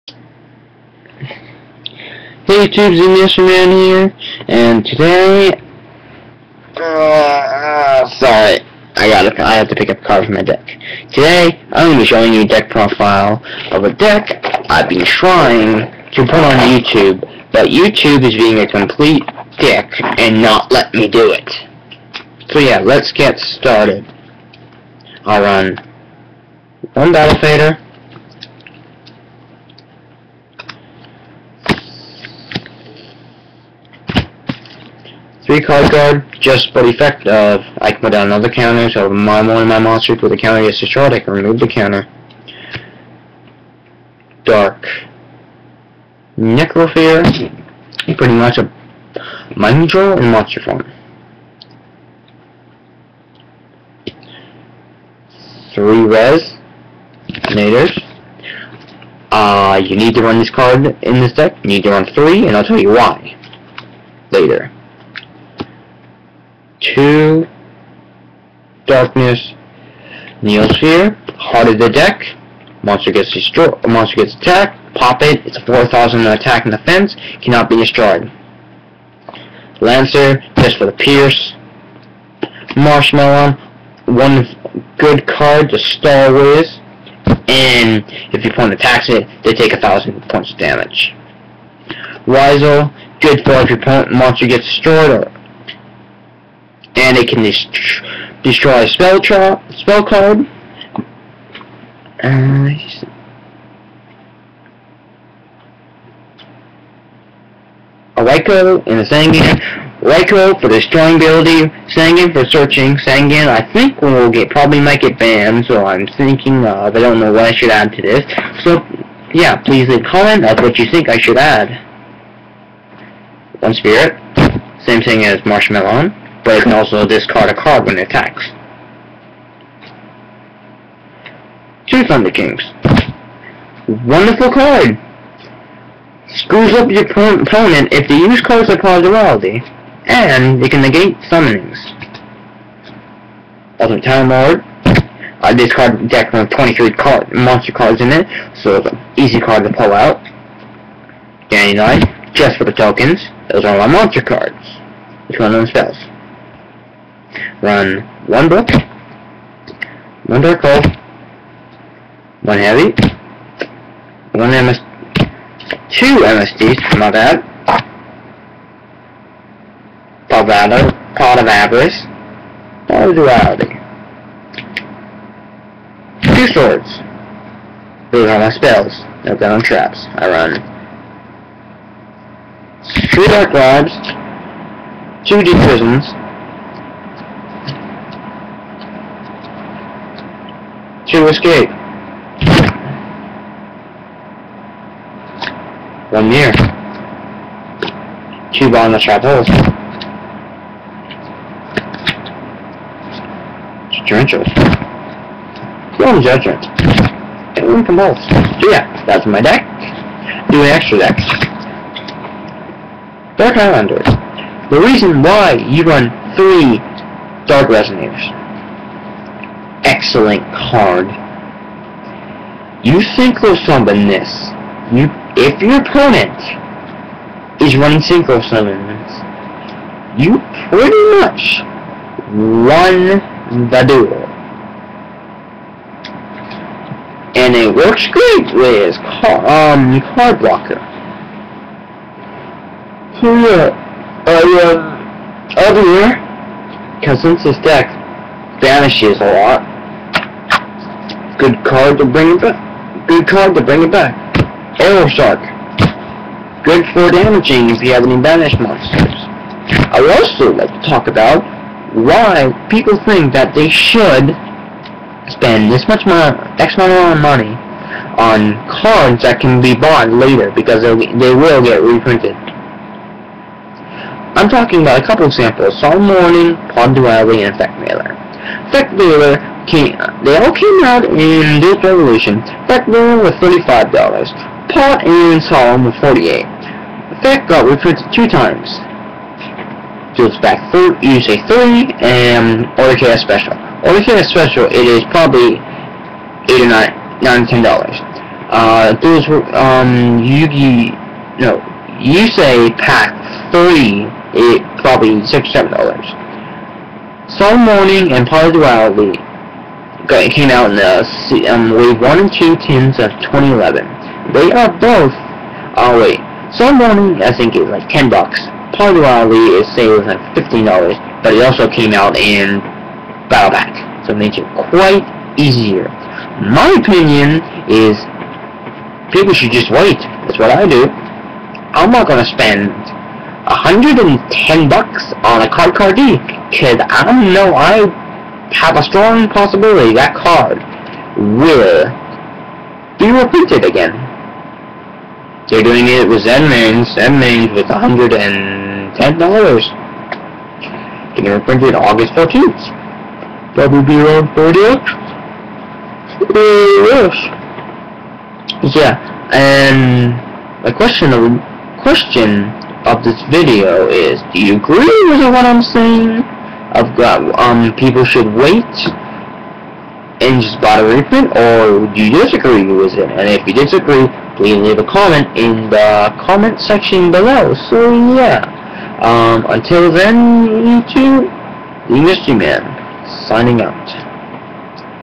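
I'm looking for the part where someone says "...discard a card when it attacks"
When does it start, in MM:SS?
02:07.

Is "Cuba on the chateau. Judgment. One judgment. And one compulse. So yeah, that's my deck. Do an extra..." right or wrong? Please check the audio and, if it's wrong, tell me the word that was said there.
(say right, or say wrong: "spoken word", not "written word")
right.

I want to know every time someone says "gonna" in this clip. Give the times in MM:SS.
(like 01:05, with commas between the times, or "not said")
00:11, 05:32.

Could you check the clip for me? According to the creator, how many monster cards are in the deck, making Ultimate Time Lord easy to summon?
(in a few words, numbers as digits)
23.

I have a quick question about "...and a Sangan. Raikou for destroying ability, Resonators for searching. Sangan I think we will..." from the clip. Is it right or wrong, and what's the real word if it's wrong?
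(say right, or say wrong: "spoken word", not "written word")
wrong: "Sangan", not "Resonators".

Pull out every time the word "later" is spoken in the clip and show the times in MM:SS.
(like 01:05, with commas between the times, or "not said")
01:04, 04:30.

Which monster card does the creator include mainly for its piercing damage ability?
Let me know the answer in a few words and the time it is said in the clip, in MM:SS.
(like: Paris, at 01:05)
Lancer, at 01:19.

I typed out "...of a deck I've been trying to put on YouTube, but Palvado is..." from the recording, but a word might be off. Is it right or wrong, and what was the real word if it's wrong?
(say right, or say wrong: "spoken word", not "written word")
wrong: "YouTube", not "Palvado".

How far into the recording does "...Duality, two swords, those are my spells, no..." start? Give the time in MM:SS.
02:53.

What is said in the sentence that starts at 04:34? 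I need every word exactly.
I'm talking about a couple examples, Solemn Warning, Pond Duality, and Effect Veiler.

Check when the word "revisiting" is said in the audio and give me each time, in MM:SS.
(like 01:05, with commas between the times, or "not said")
not said.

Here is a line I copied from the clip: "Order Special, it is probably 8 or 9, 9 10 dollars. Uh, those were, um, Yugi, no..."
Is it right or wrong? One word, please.
right.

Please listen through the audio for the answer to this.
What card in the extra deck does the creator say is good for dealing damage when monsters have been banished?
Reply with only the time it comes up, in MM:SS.
04:14.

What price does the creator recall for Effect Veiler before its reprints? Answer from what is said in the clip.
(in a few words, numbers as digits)
$35.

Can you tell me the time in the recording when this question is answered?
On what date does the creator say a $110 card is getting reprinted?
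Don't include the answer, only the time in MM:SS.
05:51.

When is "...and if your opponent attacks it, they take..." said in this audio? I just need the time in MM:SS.
01:27.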